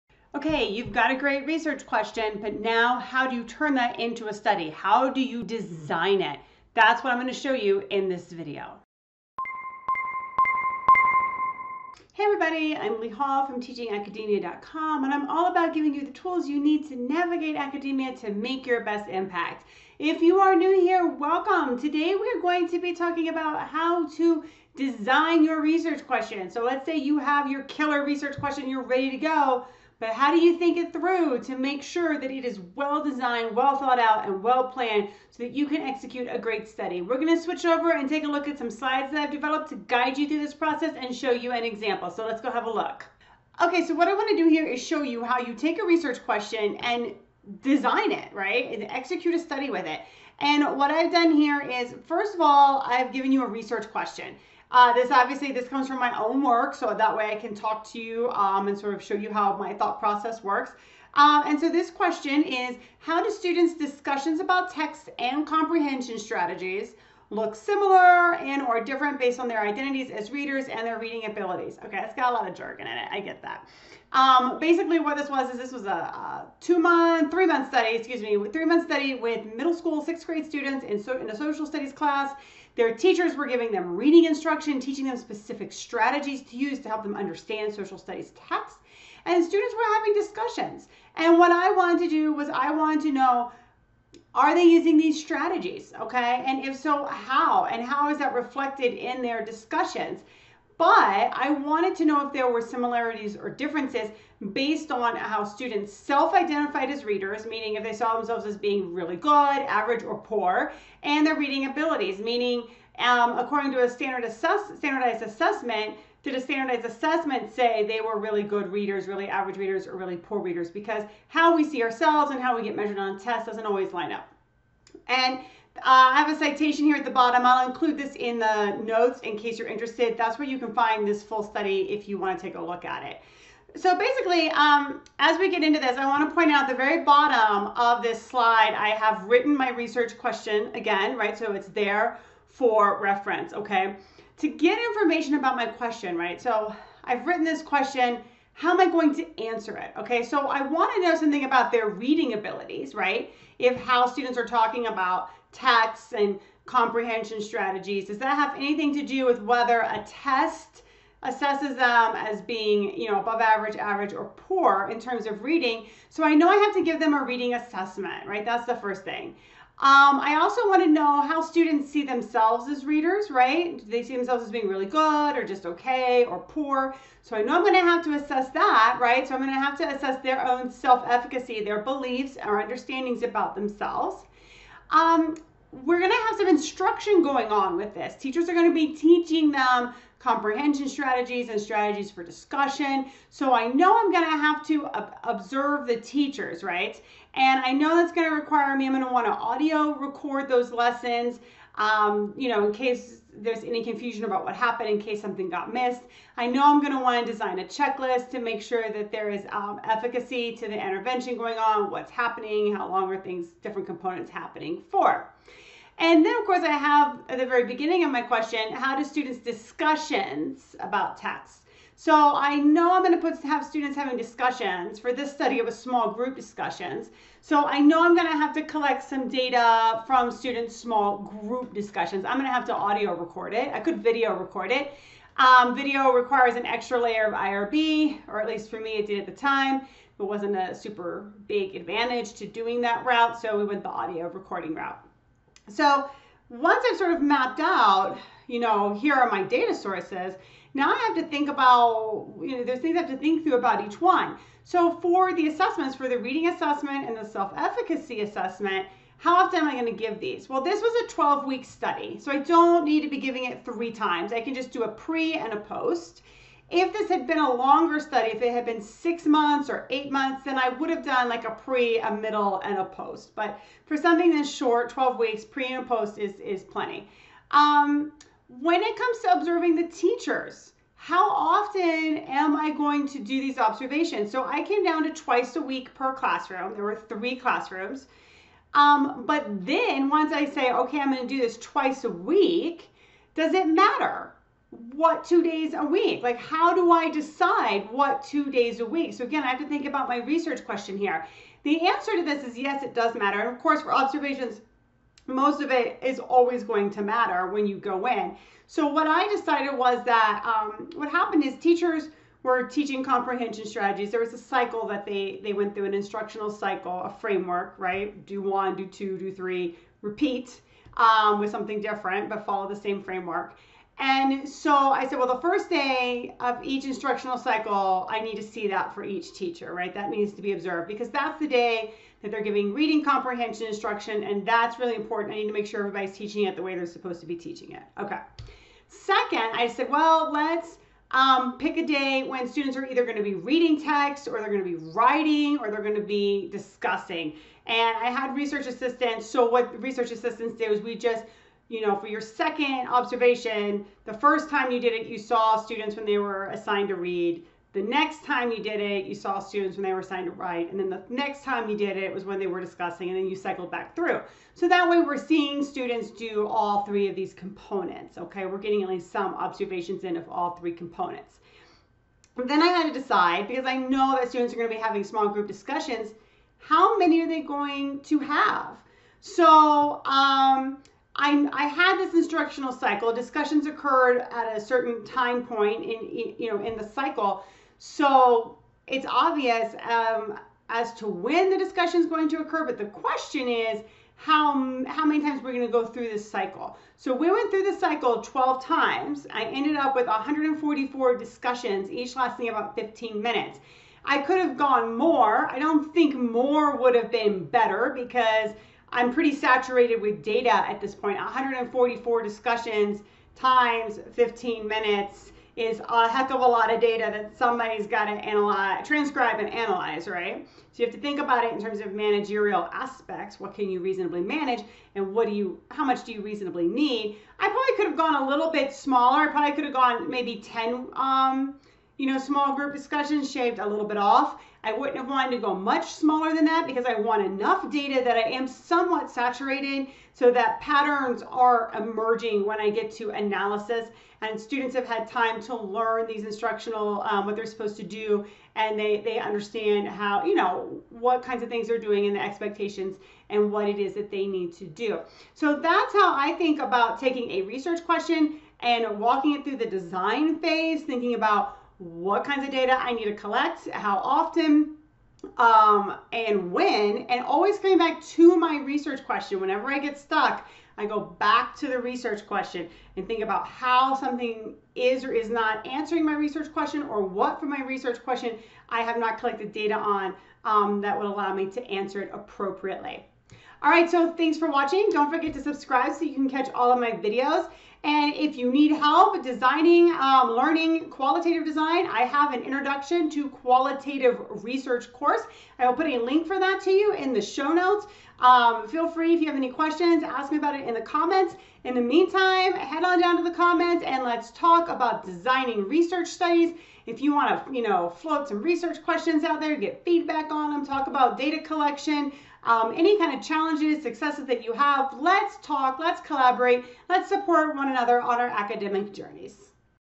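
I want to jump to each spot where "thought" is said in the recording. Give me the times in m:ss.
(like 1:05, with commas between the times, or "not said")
0:33, 0:59.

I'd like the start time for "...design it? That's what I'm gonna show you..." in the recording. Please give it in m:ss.
0:05.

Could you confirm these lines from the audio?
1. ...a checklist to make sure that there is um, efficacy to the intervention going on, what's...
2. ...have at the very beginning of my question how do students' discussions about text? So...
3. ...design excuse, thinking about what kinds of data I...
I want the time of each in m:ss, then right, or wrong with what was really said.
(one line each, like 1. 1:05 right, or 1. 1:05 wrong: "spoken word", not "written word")
1. 3:27 right
2. 3:36 right
3. 7:39 wrong: "phase", not "excuse".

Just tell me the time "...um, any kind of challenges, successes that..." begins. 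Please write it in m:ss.
8:32.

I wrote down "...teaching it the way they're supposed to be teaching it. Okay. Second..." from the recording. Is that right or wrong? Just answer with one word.
right.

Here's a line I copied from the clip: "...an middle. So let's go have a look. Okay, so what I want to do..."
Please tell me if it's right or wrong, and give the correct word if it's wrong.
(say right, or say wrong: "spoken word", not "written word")
wrong: "example", not "middle".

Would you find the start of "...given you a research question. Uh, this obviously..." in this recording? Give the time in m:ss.
0:53.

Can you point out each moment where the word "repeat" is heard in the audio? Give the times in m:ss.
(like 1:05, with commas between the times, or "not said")
5:20.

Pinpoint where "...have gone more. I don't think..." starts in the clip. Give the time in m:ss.
6:44.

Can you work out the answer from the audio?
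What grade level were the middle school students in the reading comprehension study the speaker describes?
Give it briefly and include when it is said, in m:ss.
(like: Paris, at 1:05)
sixth grade, at 1:20.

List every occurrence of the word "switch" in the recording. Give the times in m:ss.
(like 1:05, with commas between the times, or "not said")
0:37.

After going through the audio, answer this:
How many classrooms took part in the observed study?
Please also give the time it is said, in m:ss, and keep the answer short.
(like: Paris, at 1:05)
3, at 4:46.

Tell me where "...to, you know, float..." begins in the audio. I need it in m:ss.
8:27.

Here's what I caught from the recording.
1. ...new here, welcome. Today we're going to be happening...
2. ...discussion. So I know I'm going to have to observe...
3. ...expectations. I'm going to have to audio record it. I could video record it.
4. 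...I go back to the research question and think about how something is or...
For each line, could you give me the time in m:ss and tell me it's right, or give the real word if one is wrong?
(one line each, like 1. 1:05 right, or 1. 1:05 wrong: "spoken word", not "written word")
1. 0:20 wrong: "talking", not "happening"
2. 3:12 right
3. 3:51 wrong: "discussions", not "expectations"
4. 7:50 right.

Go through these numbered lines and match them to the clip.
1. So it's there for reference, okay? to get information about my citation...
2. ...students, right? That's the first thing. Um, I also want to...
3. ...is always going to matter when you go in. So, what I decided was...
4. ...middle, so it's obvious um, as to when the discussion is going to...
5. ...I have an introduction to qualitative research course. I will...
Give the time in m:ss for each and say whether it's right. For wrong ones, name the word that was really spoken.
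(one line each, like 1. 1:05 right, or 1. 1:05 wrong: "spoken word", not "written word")
1. 2:21 wrong: "question", not "citation"
2. 2:47 wrong: "assessment", not "students"
3. 5:06 right
4. 6:26 wrong: "cycle", not "middle"
5. 8:11 right.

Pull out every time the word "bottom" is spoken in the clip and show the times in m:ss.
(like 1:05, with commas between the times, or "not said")
2:07, 2:17.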